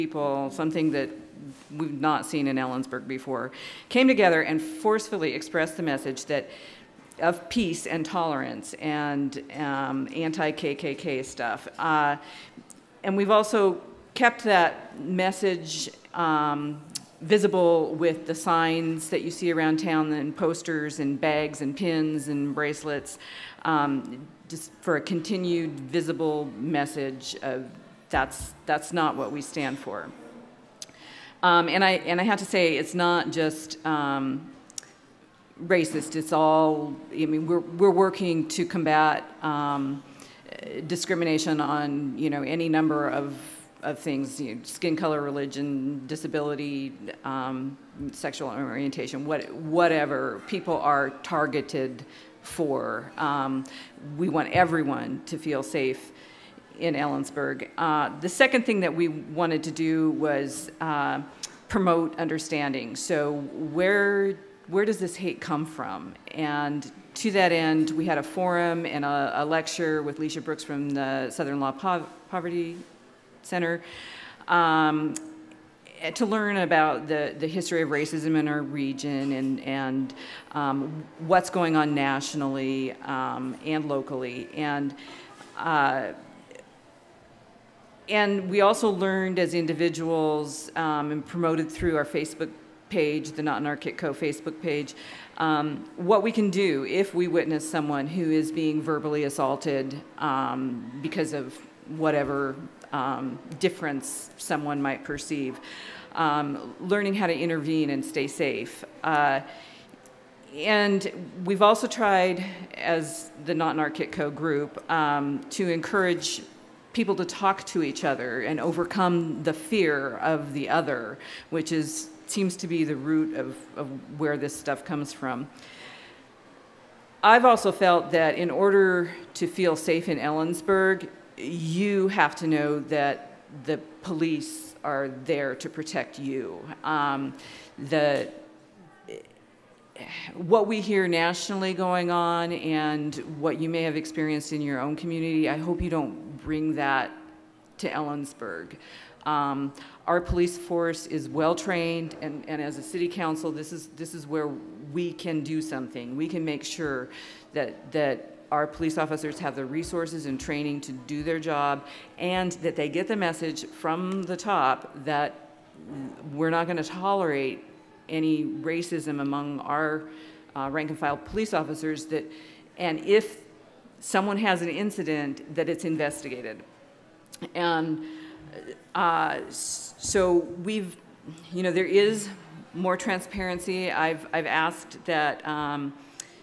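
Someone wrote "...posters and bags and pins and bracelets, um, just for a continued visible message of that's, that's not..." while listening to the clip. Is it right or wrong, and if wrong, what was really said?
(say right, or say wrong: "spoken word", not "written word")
right.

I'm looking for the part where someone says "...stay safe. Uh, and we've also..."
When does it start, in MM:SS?
01:48.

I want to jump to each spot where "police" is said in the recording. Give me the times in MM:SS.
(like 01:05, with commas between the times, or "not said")
02:14, 02:30, 02:38, 02:51.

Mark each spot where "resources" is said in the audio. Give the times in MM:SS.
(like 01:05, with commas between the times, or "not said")
02:39.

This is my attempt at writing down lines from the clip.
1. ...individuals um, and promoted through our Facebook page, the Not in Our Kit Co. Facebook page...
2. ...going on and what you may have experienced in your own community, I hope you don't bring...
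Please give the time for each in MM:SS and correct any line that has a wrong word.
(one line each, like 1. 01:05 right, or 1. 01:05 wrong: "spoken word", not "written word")
1. 01:29 right
2. 02:21 right.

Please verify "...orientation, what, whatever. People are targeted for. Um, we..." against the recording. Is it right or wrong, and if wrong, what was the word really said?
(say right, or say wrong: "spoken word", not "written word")
right.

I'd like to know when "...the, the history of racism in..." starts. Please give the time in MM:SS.
01:17.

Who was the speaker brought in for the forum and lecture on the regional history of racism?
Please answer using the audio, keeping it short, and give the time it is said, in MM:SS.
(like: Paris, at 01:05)
Lecia Brooks, at 01:10.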